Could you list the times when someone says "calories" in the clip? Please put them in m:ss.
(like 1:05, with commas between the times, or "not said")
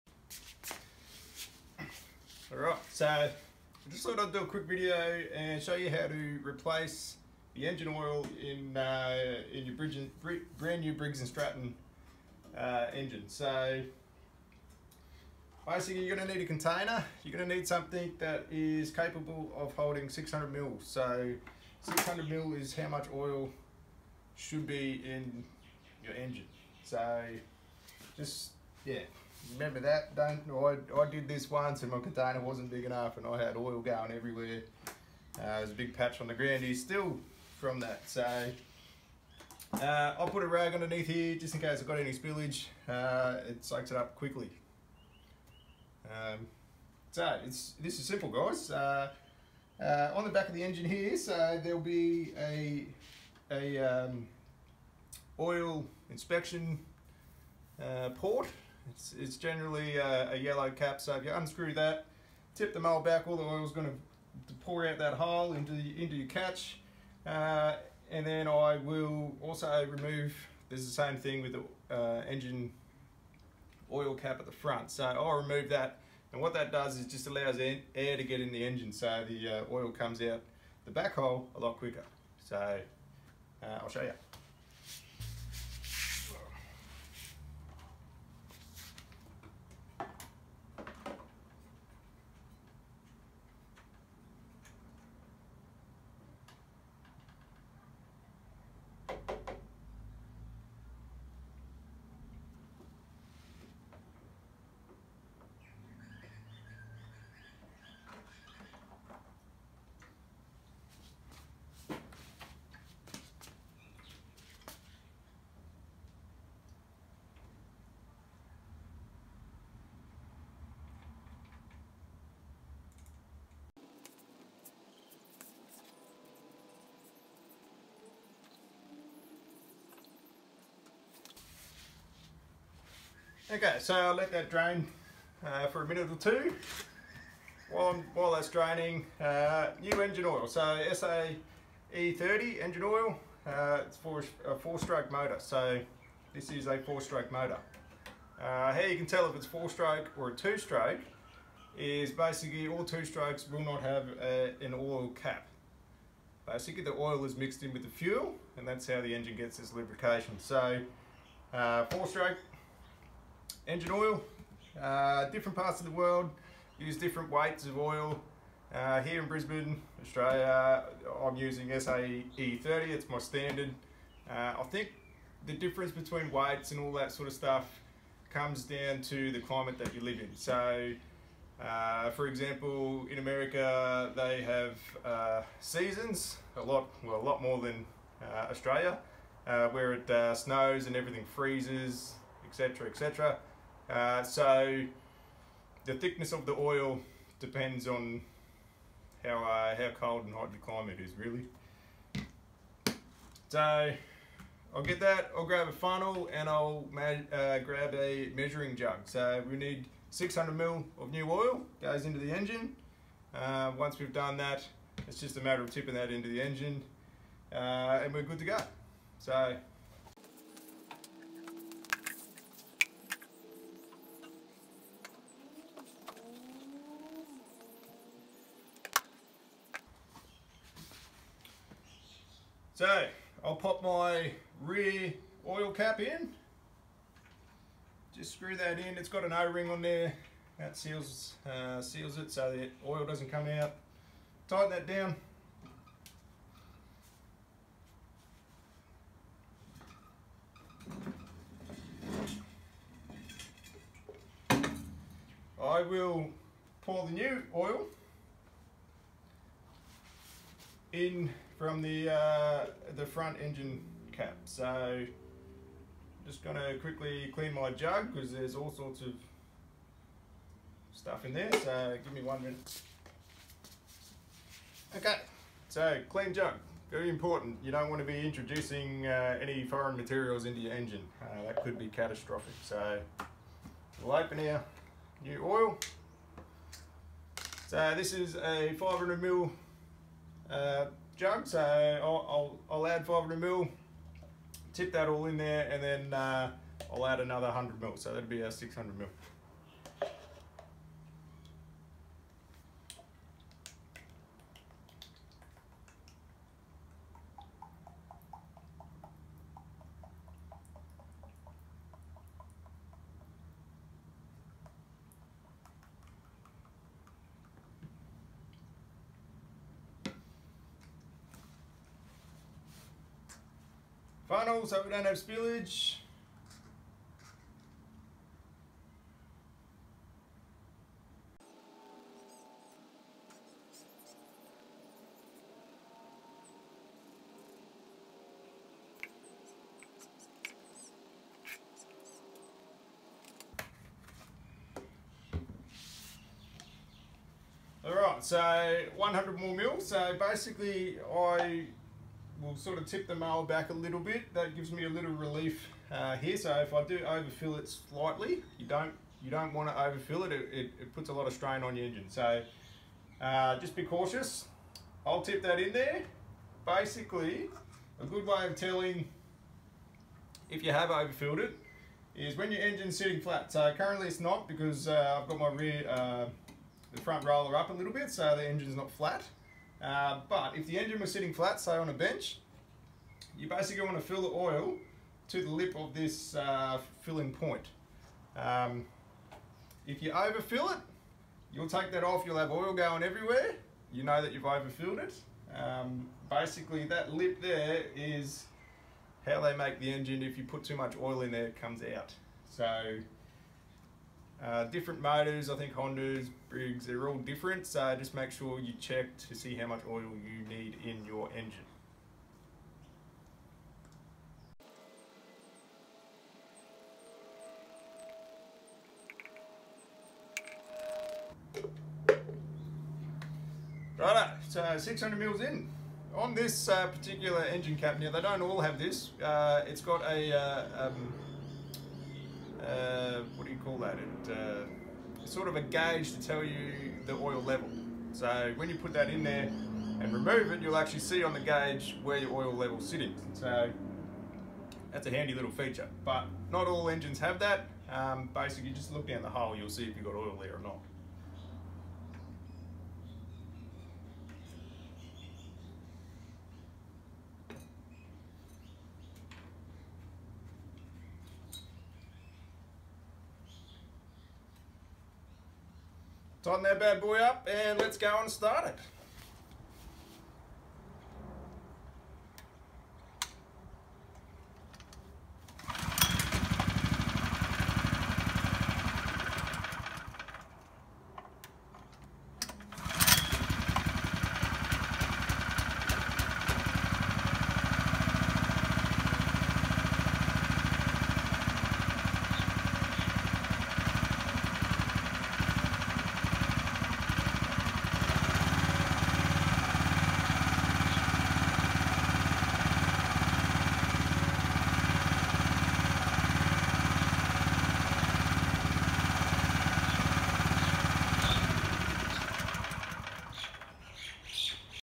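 not said.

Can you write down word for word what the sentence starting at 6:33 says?
You know that you've overfilled it.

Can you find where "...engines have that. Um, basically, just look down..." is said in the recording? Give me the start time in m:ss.
7:26.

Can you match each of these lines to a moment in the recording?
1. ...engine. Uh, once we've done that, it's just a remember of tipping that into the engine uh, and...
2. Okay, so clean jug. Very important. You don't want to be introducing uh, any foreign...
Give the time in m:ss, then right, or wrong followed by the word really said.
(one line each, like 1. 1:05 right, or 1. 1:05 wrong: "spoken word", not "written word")
1. 3:32 wrong: "matter", not "remember"
2. 4:34 right.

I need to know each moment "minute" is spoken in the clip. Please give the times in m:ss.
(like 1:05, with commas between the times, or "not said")
2:15, 4:32.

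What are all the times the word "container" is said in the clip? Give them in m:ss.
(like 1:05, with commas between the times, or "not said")
0:16, 0:31.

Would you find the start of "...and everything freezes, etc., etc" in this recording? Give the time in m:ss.
3:10.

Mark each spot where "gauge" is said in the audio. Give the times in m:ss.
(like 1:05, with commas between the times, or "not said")
7:15, 7:21.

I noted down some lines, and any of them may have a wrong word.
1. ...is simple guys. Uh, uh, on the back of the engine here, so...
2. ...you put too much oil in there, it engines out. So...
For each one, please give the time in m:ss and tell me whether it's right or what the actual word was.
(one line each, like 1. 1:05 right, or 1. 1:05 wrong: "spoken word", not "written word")
1. 0:47 right
2. 6:40 wrong: "comes", not "engines".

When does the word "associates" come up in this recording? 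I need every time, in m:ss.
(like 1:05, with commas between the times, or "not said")
not said.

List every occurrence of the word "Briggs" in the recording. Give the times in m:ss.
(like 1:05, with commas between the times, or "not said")
0:10, 6:46.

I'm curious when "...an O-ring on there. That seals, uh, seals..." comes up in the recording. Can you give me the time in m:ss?
3:59.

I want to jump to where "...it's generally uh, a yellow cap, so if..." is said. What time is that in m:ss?
0:59.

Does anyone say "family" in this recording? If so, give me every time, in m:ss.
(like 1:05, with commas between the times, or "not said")
not said.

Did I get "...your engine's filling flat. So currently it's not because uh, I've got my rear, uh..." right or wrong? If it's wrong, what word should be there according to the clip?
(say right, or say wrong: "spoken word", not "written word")
wrong: "sitting", not "filling".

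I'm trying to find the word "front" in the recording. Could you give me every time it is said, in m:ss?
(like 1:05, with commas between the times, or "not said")
1:14, 4:23, 6:17.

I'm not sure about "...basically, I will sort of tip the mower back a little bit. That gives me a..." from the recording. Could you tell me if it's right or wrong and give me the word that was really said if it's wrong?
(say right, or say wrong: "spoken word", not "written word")
right.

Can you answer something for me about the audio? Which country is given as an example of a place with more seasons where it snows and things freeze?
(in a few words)
America.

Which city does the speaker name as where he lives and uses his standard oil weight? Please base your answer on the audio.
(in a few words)
Brisbane.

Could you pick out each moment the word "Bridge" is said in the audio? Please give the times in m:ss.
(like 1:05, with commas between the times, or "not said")
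0:09.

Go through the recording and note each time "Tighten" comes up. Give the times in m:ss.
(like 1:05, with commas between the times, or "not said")
4:04, 7:46.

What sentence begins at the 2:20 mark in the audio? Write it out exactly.
So SA E30 engine oil, uh, it's for a four-stroke motor.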